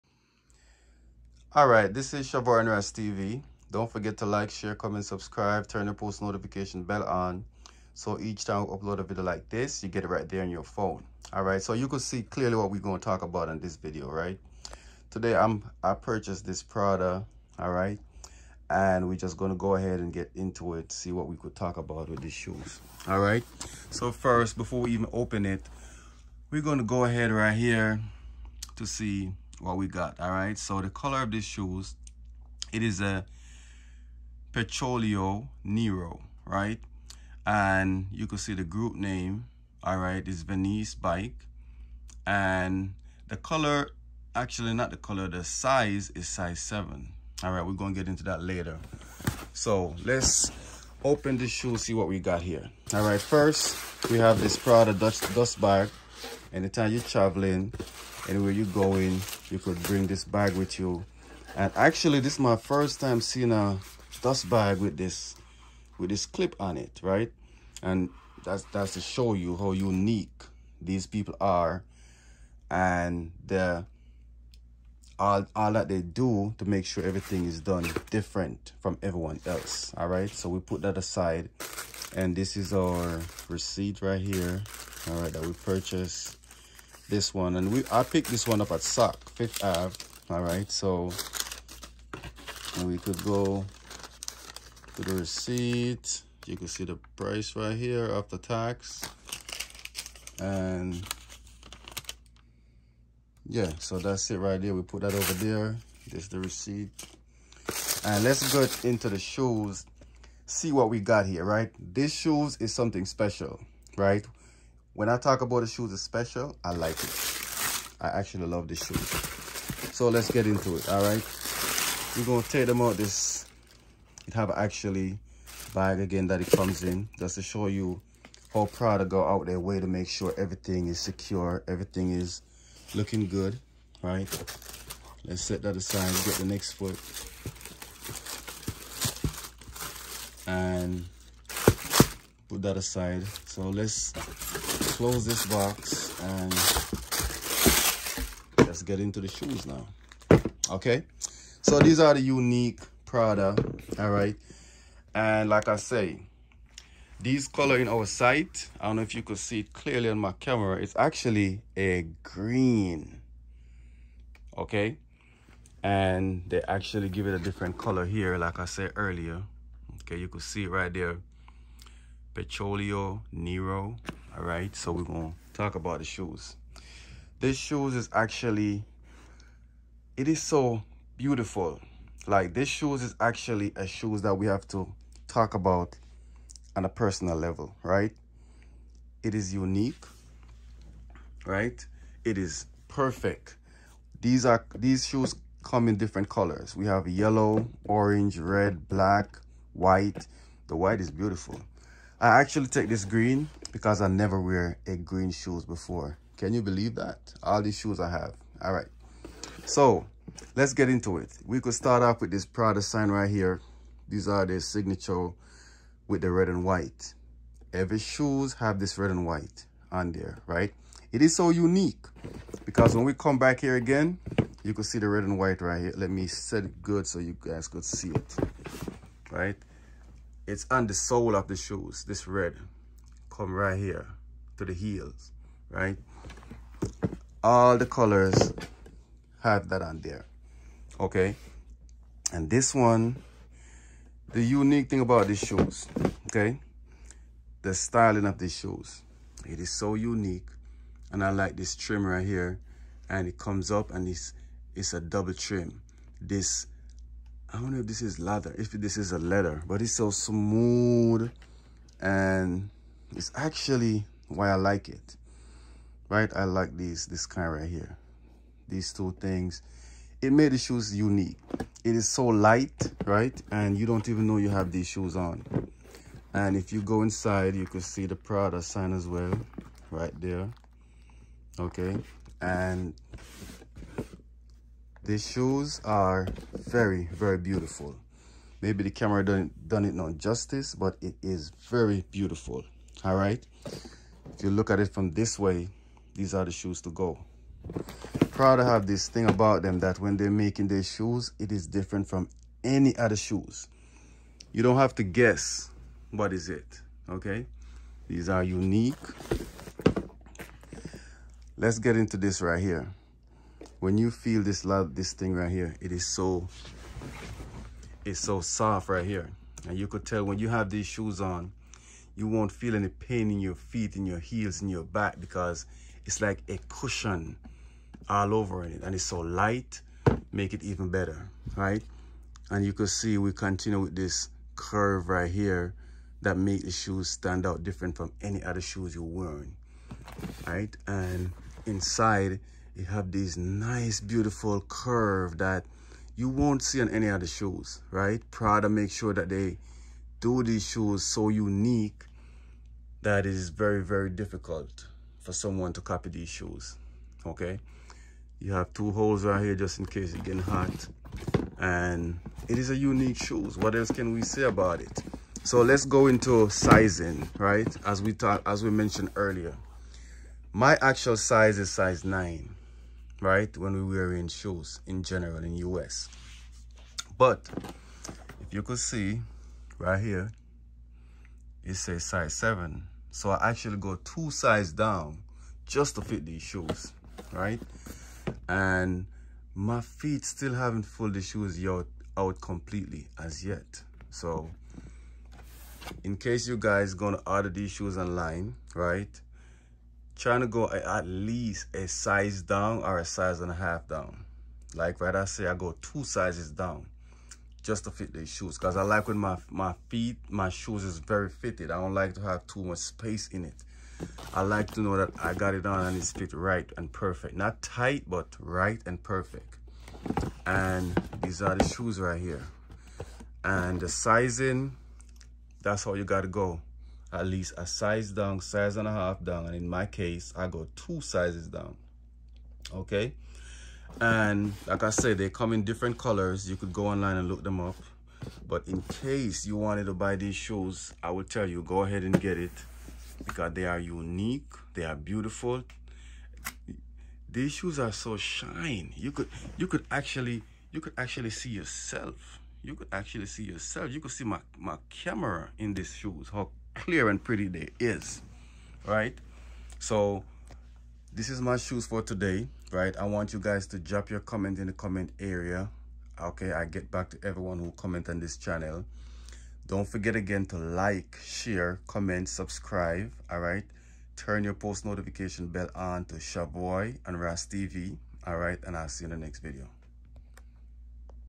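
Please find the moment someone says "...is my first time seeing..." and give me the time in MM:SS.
01:02.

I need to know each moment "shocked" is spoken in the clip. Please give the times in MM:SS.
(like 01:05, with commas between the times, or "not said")
not said.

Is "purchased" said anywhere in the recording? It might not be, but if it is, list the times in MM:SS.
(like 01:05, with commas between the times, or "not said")
00:15, 01:25.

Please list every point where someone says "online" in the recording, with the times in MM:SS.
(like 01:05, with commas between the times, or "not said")
06:37, 07:16.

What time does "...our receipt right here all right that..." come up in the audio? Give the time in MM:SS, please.
01:22.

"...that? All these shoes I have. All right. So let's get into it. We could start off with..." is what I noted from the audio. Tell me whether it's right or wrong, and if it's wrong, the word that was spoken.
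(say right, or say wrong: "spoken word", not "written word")
right.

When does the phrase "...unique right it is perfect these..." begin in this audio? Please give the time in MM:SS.
03:09.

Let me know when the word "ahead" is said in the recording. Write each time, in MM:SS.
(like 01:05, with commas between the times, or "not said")
00:19, 00:27, 07:21.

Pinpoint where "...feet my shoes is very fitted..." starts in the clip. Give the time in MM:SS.
06:49.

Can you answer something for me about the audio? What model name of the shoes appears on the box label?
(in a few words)
Vernice bike.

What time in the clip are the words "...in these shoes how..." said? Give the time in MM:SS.
07:35.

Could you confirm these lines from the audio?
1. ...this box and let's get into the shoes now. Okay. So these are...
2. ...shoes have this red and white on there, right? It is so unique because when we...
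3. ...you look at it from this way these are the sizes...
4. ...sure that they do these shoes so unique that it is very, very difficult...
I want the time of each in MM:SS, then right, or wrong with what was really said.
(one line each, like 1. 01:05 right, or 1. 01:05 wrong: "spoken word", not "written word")
1. 02:25 right
2. 03:37 right
3. 04:54 wrong: "shoes", not "sizes"
4. 05:48 right.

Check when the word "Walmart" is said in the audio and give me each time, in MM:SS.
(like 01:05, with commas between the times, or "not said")
not said.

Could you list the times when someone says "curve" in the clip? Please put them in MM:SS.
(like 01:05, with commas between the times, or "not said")
05:34, 05:44.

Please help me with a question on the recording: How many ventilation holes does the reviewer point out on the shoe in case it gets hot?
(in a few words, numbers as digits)
2.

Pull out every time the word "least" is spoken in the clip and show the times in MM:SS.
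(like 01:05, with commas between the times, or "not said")
06:41, 07:07.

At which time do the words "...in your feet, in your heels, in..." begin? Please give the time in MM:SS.
05:23.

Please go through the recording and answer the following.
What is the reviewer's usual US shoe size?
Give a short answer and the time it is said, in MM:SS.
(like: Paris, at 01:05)
9, at 06:11.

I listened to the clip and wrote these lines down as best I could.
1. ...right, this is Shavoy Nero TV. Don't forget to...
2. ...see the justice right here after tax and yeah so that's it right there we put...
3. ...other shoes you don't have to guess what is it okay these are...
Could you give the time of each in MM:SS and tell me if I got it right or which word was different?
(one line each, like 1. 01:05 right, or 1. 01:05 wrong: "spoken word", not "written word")
1. 00:01 wrong: "Ras", not "Nero"
2. 01:36 wrong: "price", not "justice"
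3. 05:02 right.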